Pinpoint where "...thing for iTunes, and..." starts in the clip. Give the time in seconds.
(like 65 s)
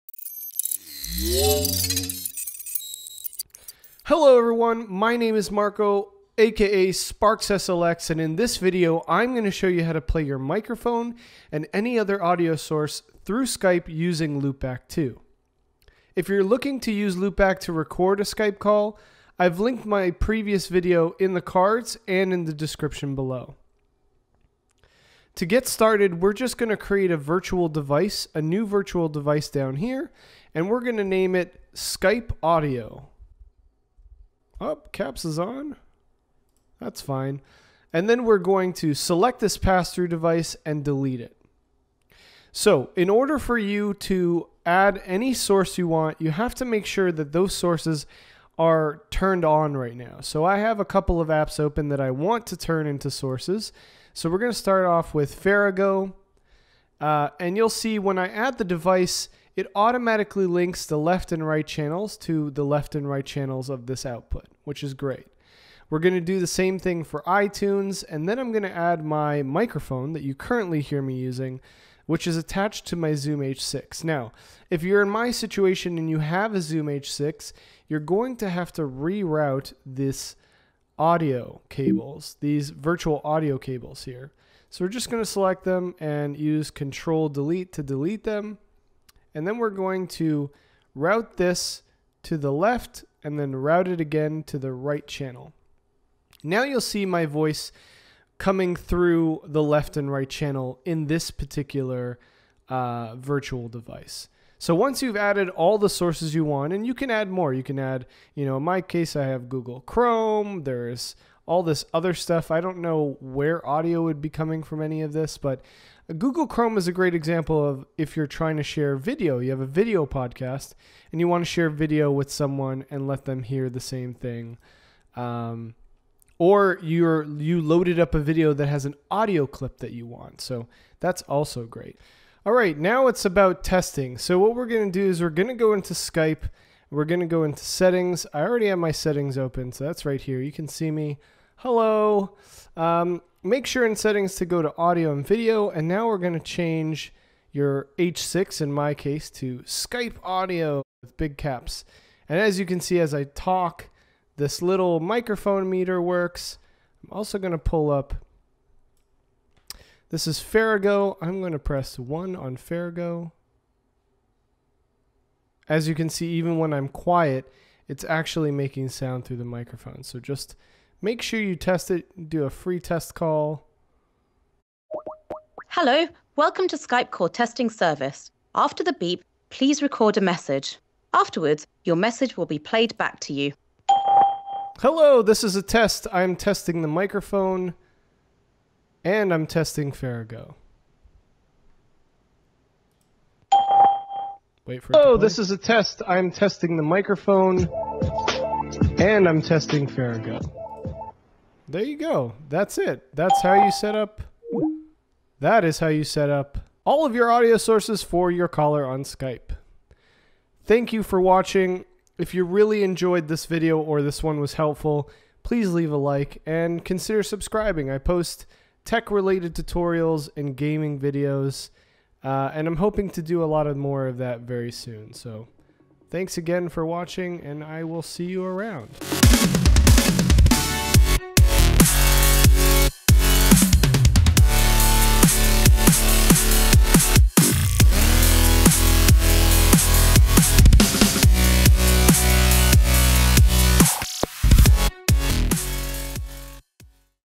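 66 s.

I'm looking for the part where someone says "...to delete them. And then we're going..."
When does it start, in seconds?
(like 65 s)
87 s.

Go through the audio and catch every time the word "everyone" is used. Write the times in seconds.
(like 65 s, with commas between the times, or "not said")
4 s.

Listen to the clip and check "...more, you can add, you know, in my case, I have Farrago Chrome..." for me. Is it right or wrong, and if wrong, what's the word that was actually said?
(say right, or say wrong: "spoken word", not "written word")
wrong: "Google", not "Farrago".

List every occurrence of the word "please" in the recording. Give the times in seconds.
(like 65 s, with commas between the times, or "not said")
179 s, 215 s.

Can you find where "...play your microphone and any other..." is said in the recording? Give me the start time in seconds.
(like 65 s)
10 s.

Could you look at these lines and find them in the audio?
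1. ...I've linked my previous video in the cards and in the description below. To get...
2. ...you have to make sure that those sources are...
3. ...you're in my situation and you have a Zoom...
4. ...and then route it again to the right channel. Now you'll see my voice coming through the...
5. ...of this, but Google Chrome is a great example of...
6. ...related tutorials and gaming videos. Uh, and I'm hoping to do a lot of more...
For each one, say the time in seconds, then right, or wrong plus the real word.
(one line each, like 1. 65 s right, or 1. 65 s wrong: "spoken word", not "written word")
1. 19 s right
2. 46 s right
3. 74 s right
4. 93 s right
5. 115 s right
6. 219 s right.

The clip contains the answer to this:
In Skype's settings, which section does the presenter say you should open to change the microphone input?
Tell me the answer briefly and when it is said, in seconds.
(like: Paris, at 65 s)
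audio and video, at 144 s.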